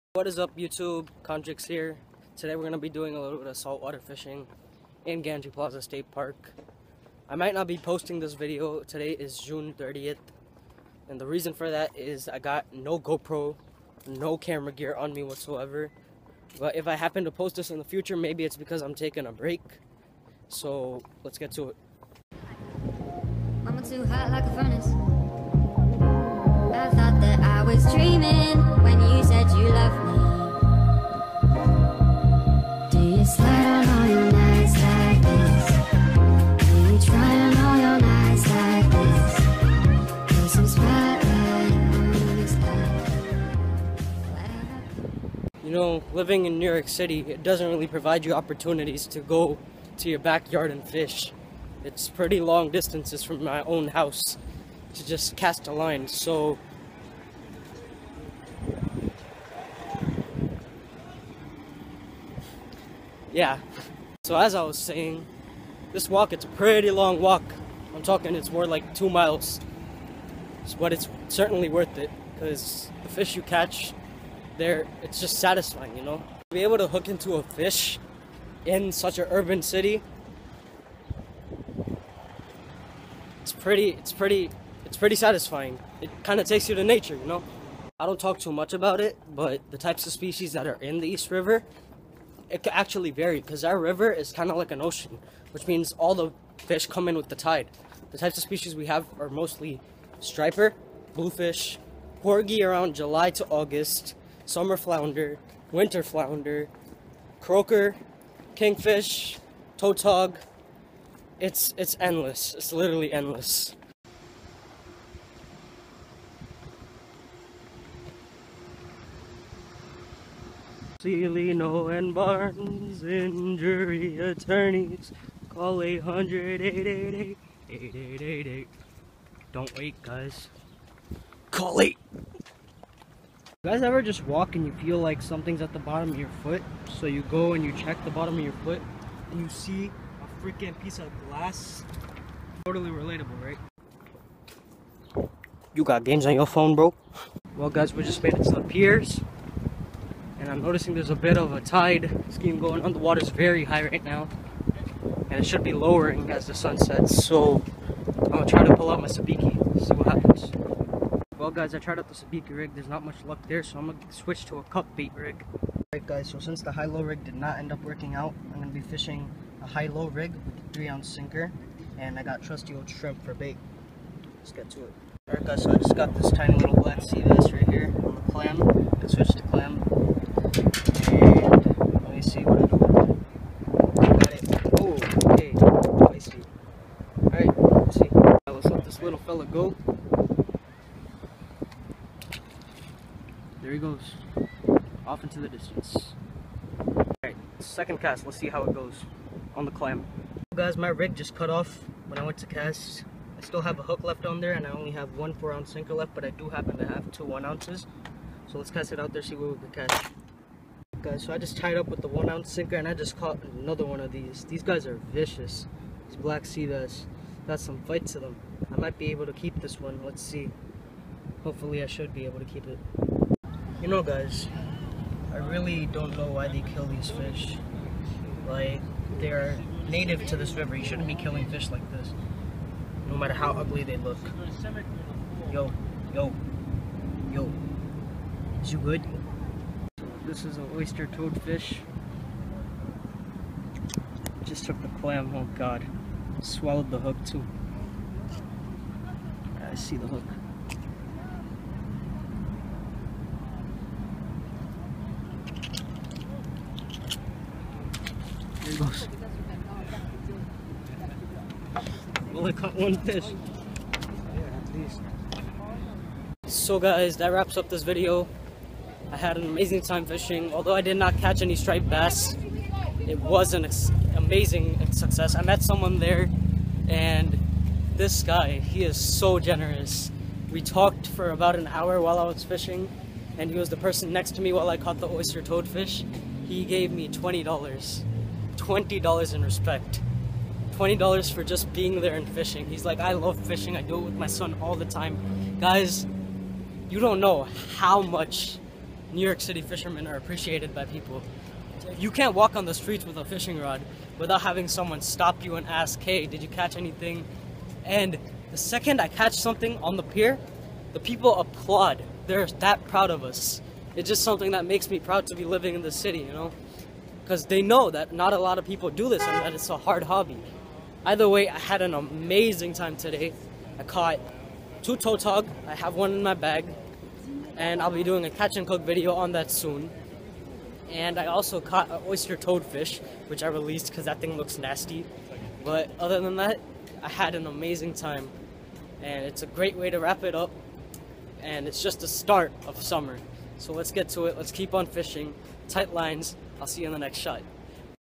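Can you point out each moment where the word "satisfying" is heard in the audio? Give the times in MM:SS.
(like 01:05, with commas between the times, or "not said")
01:15, 01:25.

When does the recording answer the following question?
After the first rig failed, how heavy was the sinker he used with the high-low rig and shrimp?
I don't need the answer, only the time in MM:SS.
02:50.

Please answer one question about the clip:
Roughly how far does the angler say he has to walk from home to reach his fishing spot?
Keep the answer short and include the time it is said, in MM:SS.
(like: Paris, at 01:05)
2 miles, at 01:08.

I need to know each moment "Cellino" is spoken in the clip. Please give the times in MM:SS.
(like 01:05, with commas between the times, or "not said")
02:01.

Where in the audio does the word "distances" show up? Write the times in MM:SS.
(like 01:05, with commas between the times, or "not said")
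00:52, 03:15.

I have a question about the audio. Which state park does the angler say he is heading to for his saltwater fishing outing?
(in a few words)
Gantry Plaza State Park.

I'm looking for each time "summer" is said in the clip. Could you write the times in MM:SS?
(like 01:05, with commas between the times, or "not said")
01:44, 05:42.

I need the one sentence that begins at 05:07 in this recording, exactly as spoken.
And the second I catch something on the pier, the people applaud.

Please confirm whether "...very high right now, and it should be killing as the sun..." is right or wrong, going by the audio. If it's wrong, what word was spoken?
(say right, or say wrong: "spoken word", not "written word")
wrong: "lowering", not "killing".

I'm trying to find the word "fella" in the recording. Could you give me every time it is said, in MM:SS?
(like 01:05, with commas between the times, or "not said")
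03:09.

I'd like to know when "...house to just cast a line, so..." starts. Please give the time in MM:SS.
00:53.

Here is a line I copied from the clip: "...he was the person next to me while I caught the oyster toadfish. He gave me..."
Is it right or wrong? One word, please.
right.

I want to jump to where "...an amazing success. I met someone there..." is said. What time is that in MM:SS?
04:33.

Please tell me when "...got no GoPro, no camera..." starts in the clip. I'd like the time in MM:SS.
00:12.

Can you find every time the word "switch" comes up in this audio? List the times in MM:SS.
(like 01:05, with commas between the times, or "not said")
02:44, 02:59.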